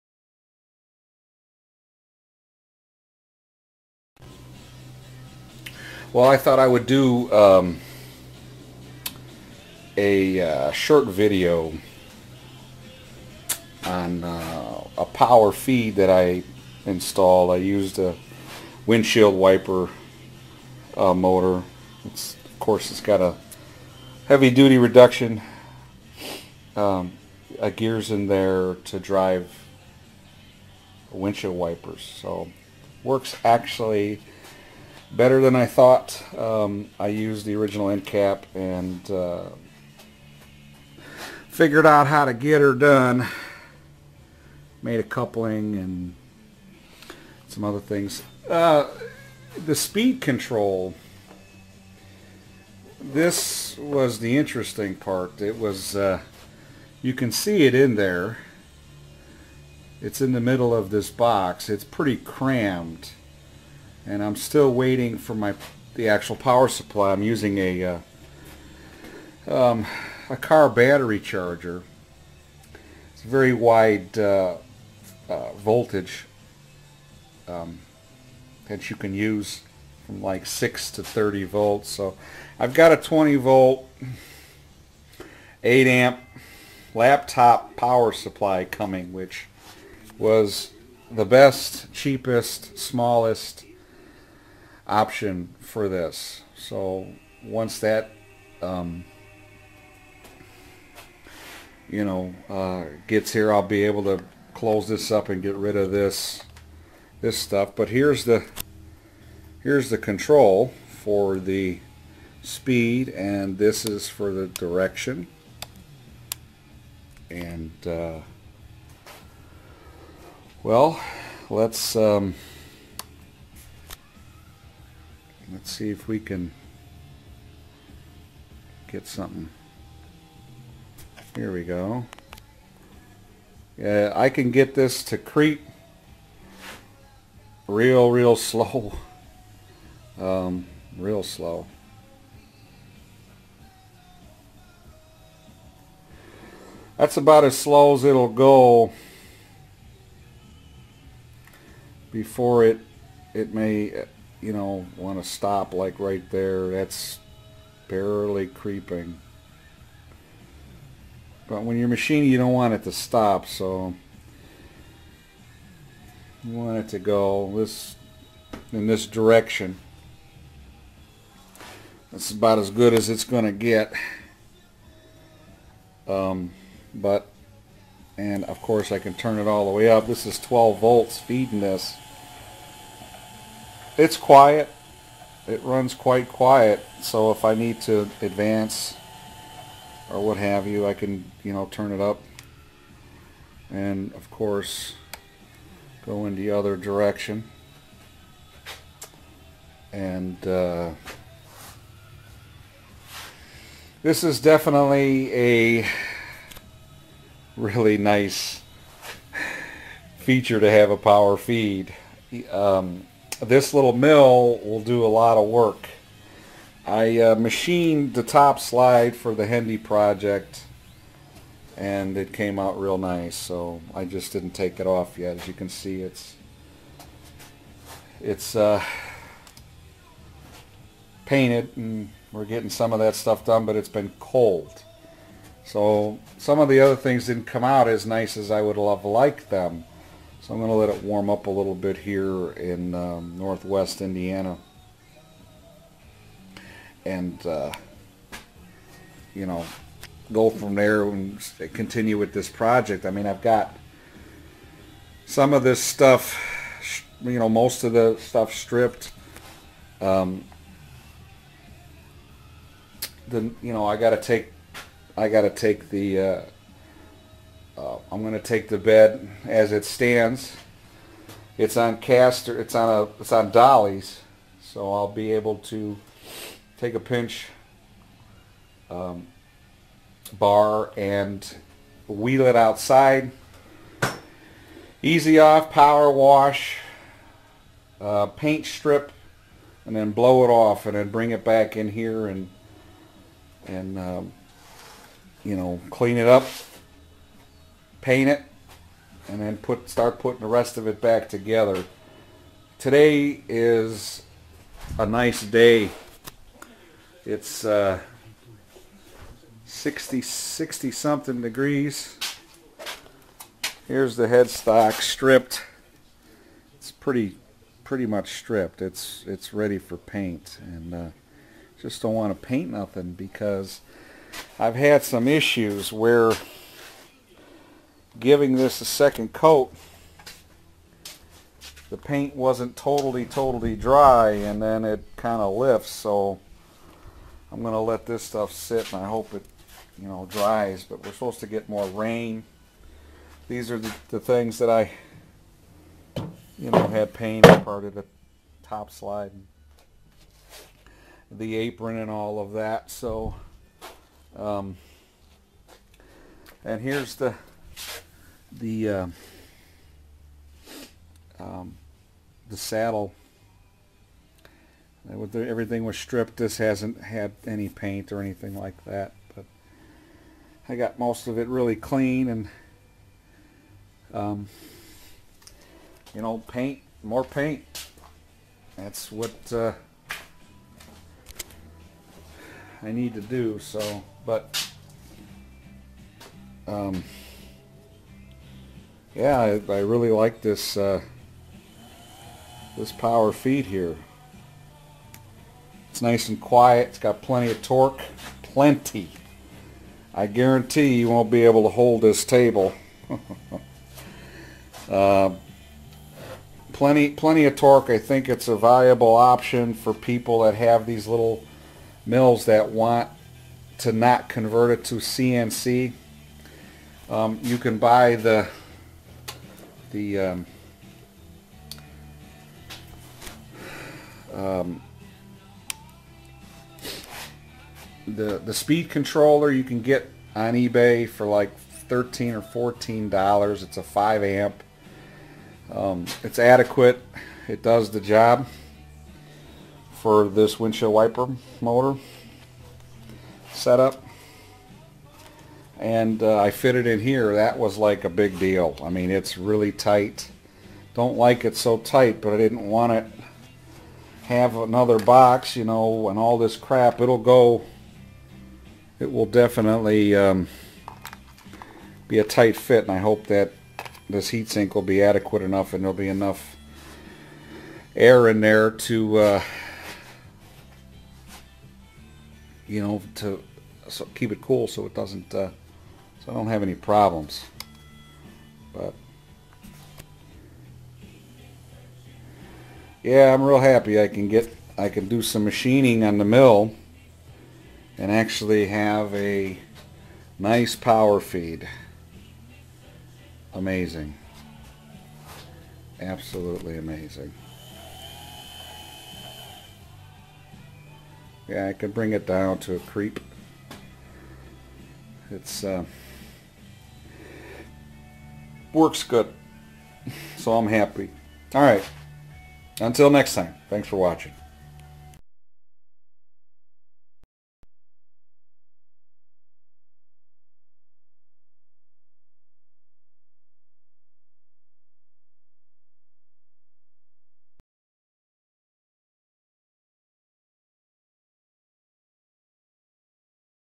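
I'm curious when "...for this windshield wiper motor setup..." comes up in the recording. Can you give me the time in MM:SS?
07:19.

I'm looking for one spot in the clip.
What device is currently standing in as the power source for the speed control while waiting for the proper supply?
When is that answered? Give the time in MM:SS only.
01:10.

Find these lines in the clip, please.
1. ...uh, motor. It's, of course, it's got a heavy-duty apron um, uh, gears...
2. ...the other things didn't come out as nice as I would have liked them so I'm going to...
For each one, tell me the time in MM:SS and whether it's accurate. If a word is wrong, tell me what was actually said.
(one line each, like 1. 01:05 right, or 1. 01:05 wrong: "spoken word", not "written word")
1. 00:20 wrong: "reduction", not "apron"
2. 03:56 right.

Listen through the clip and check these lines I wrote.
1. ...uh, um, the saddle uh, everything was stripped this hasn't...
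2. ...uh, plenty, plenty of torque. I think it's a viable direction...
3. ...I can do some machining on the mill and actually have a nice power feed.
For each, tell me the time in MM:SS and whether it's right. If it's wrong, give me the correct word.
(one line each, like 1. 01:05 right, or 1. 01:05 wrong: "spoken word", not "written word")
1. 05:58 right
2. 06:44 wrong: "option", not "direction"
3. 08:04 right.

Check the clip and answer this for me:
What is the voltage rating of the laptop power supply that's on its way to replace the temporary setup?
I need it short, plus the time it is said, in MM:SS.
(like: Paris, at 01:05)
20 volt, at 01:22.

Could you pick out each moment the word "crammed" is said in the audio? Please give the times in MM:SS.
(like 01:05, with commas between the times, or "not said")
01:02.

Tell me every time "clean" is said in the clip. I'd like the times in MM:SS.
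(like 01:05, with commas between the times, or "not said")
04:55, 06:11.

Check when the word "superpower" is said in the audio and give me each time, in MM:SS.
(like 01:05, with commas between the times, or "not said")
not said.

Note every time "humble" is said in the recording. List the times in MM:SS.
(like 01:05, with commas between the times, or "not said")
not said.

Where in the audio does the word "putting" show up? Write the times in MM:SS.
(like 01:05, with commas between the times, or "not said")
05:00.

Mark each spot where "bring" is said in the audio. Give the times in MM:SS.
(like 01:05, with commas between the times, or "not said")
04:51, 08:21.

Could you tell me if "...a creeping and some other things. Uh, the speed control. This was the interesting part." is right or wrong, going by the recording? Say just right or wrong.
wrong.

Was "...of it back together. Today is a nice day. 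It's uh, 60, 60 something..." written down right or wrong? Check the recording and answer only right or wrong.
right.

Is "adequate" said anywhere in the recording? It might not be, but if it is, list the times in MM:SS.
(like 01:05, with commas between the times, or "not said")
07:16, 07:45.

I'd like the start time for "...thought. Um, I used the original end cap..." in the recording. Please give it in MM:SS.
00:35.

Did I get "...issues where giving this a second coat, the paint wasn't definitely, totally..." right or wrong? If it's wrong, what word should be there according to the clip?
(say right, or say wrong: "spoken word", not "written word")
wrong: "totally", not "definitely".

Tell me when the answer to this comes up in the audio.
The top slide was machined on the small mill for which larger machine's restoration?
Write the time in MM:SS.
03:39.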